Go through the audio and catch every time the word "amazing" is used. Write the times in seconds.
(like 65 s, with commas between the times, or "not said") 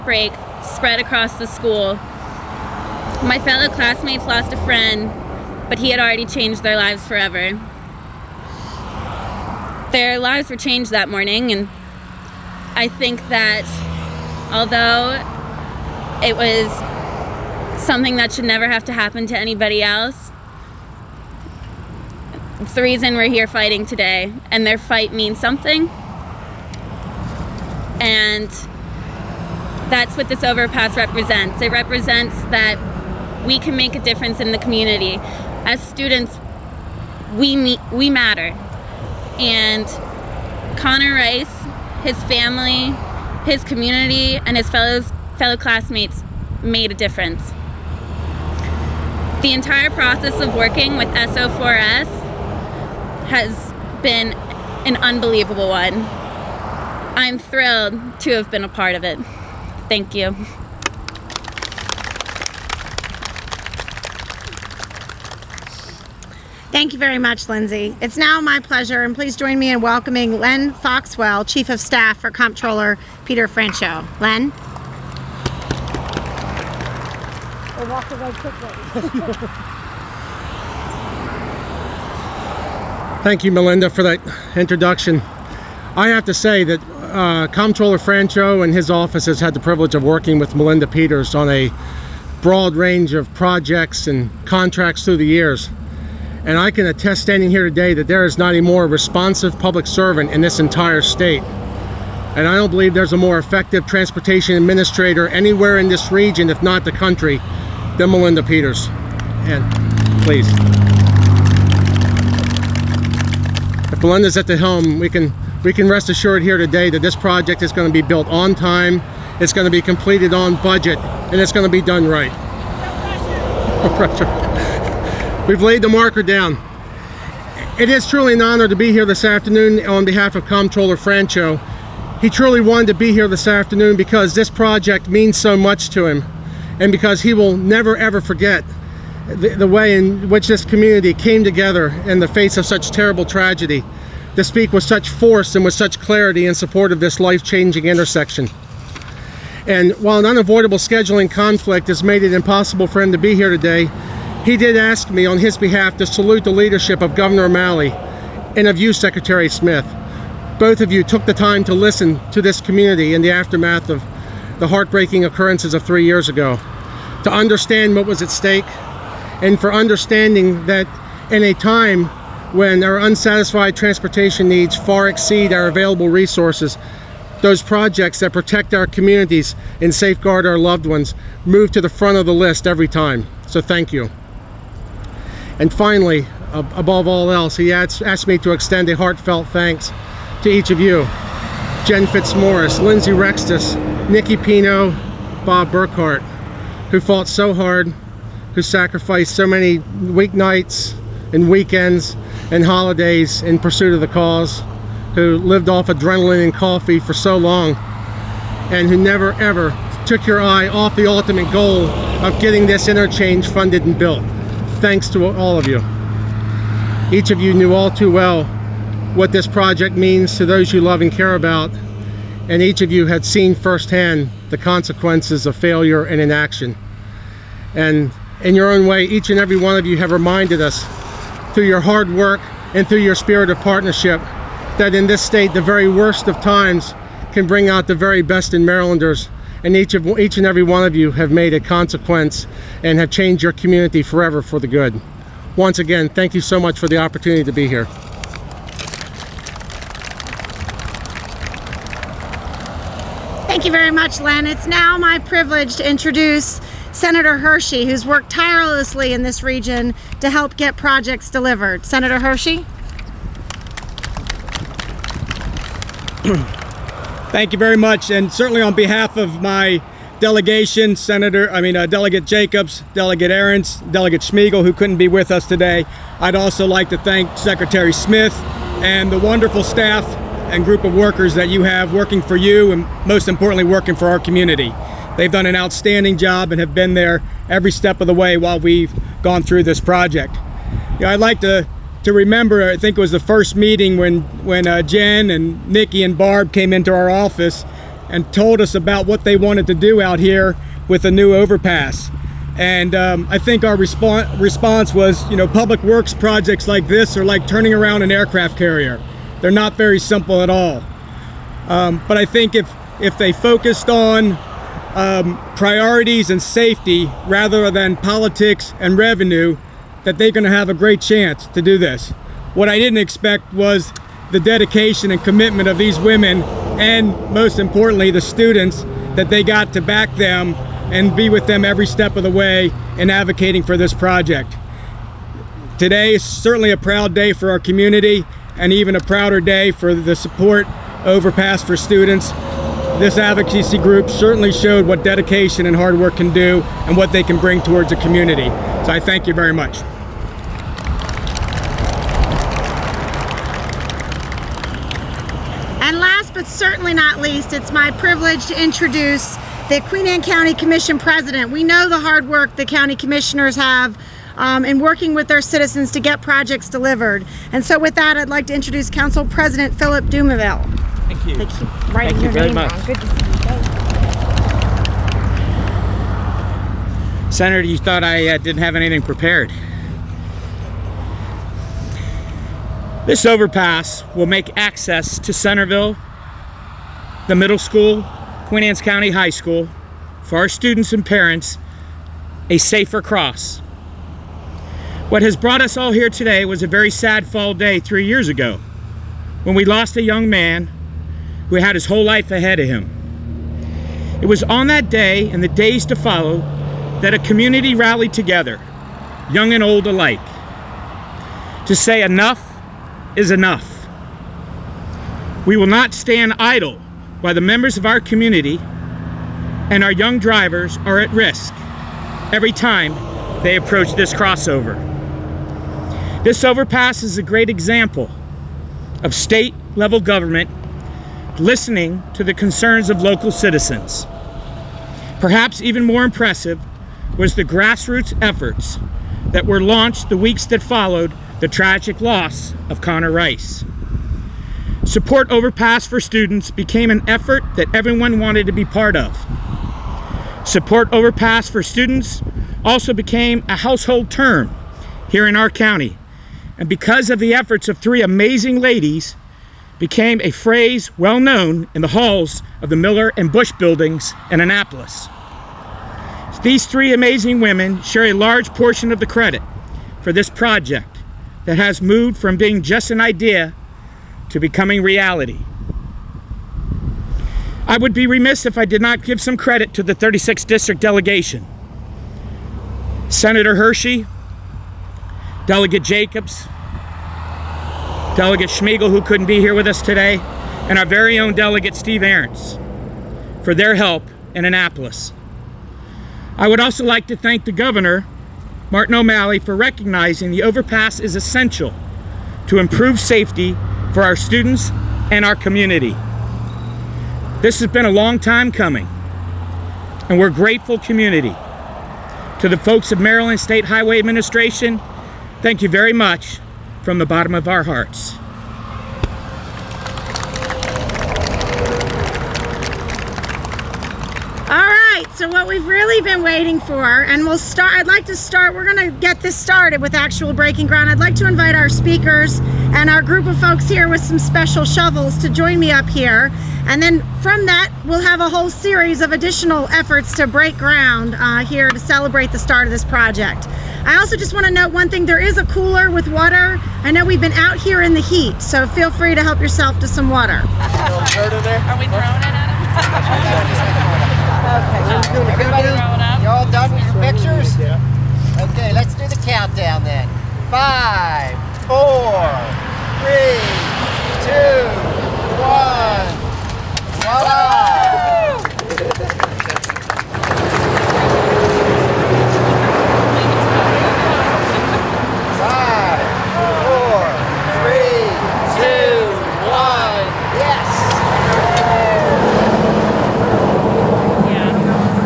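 458 s, 466 s.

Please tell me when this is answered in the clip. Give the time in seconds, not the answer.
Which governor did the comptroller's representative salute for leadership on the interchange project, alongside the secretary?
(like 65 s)
157 s.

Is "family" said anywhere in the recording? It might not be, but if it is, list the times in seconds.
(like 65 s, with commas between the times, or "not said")
42 s.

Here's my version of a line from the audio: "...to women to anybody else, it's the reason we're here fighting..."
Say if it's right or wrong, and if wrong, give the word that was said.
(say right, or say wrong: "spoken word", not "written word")
wrong: "happen", not "women".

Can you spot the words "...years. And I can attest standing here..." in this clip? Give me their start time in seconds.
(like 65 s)
95 s.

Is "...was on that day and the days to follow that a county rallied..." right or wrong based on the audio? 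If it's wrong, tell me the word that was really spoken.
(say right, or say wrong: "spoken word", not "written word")
wrong: "community", not "county".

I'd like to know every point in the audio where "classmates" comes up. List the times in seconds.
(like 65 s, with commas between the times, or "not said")
3 s, 45 s.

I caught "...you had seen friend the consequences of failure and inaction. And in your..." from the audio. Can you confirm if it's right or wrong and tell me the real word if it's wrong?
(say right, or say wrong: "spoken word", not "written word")
wrong: "firsthand", not "friend".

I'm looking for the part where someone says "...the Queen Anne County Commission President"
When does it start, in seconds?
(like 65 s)
359 s.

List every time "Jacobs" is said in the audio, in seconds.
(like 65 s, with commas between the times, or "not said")
272 s, 485 s.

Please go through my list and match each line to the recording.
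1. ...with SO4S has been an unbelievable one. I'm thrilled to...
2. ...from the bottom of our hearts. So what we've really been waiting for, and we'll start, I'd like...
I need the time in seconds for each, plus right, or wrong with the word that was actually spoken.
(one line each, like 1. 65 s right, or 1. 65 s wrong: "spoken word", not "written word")
1. 50 s right
2. 516 s right.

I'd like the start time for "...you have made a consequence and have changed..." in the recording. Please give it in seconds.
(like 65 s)
240 s.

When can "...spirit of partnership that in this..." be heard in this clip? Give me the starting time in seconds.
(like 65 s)
233 s.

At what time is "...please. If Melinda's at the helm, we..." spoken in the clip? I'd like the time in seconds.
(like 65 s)
110 s.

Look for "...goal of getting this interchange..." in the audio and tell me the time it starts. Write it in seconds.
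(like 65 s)
211 s.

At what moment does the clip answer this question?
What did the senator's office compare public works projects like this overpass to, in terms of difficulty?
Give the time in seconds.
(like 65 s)
307 s.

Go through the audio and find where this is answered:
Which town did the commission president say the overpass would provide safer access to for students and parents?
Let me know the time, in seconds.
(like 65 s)
385 s.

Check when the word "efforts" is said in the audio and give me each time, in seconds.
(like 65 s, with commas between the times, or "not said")
438 s, 447 s, 457 s, 539 s.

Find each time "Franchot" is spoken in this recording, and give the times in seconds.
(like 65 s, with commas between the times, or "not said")
73 s, 87 s, 130 s.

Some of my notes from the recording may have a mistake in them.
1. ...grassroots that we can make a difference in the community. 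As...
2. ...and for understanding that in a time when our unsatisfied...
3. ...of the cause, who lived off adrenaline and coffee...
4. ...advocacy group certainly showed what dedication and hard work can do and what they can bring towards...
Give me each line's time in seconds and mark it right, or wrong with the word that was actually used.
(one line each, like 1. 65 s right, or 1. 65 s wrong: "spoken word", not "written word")
1. 31 s wrong: "represents", not "grassroots"
2. 169 s right
3. 203 s right
4. 343 s right.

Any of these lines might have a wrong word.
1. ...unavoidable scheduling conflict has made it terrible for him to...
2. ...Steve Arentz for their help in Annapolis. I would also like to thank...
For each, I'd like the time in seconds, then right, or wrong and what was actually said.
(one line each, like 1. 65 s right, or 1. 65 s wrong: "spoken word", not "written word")
1. 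150 s wrong: "impossible", not "terrible"
2. 491 s right.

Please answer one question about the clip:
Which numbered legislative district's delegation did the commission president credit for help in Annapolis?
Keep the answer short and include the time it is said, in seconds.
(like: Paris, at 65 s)
36th District, at 479 s.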